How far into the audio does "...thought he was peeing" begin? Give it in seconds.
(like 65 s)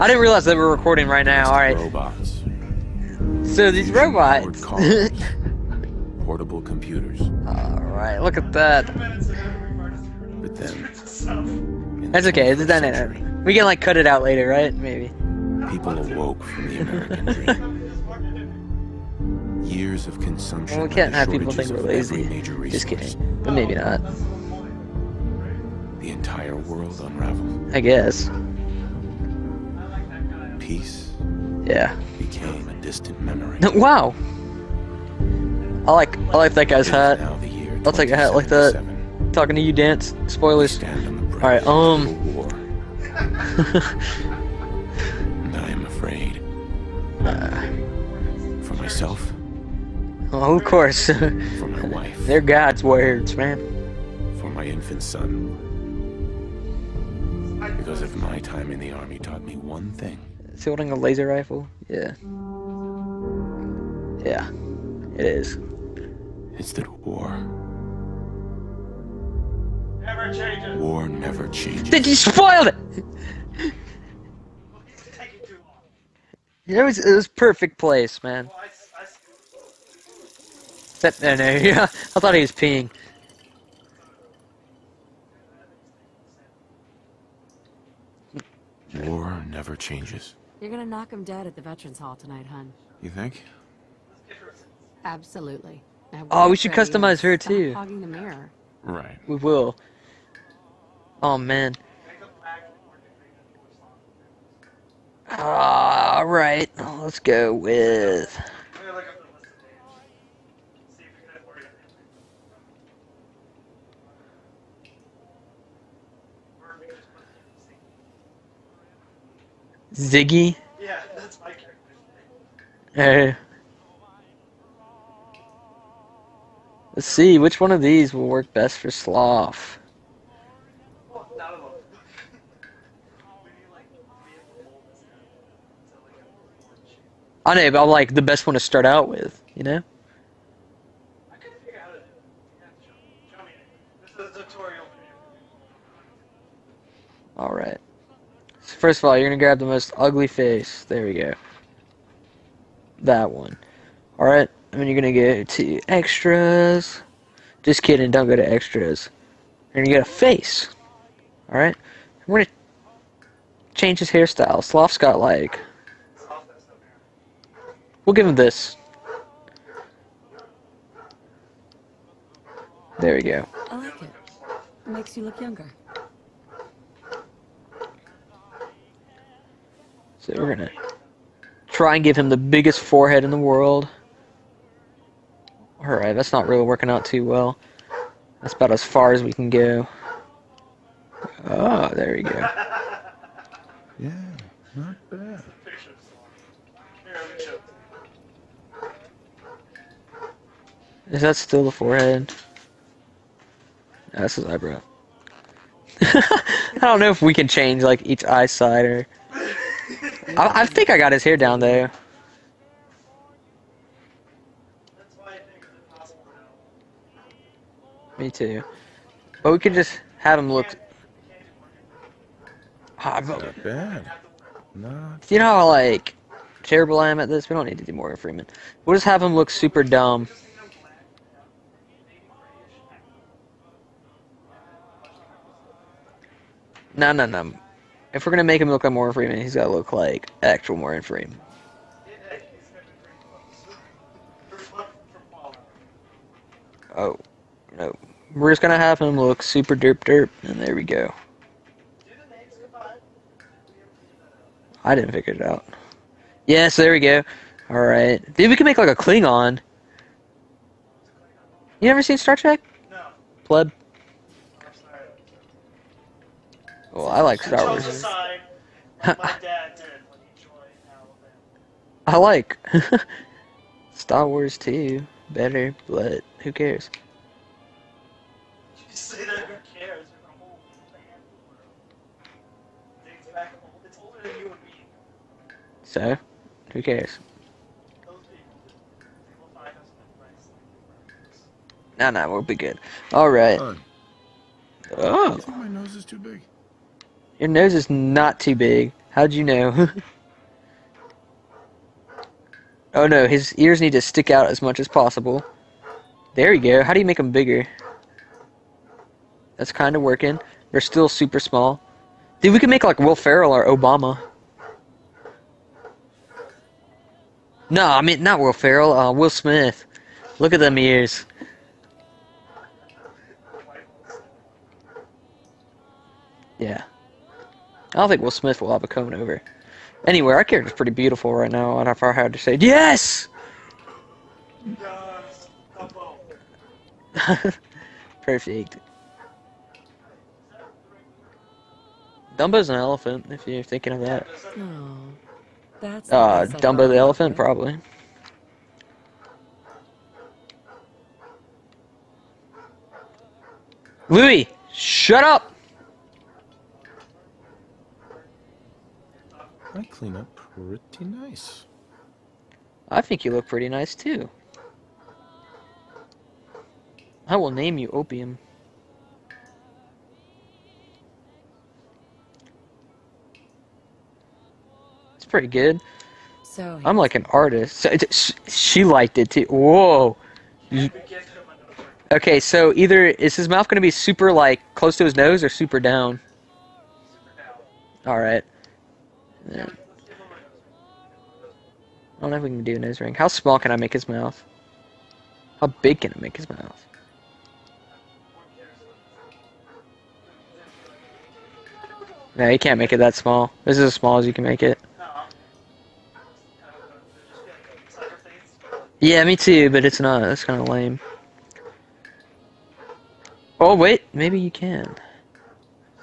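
82 s.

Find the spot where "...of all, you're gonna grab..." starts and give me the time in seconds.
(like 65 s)
149 s.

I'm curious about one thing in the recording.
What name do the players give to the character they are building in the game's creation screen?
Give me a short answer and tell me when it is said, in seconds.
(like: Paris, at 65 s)
Ziggy, at 119 s.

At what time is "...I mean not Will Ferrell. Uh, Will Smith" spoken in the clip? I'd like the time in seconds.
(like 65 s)
317 s.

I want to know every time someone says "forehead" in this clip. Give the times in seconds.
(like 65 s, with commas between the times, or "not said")
182 s, 201 s.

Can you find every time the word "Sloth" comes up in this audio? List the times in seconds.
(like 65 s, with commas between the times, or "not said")
128 s, 164 s.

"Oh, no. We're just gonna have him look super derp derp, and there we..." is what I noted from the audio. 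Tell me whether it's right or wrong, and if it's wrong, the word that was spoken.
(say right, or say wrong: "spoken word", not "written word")
right.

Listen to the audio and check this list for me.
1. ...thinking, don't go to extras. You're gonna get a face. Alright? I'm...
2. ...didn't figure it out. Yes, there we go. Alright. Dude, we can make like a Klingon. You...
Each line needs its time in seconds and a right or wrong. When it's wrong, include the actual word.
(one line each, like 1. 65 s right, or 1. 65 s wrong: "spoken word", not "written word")
1. 157 s wrong: "kidding", not "thinking"
2. 254 s right.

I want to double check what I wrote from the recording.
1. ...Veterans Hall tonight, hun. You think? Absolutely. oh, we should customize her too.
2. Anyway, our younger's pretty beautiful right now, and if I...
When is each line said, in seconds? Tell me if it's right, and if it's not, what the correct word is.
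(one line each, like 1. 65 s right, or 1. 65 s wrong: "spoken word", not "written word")
1. 91 s right
2. 330 s wrong: "character", not "younger".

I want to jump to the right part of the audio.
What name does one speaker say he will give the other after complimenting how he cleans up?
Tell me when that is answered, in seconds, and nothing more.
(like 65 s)
367 s.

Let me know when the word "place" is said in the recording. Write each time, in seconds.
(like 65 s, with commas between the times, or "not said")
77 s.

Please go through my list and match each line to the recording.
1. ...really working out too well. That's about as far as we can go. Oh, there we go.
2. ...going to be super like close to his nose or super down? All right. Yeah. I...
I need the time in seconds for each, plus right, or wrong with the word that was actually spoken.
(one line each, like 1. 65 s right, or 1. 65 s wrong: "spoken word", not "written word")
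1. 186 s right
2. 383 s right.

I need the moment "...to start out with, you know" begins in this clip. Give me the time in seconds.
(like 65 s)
138 s.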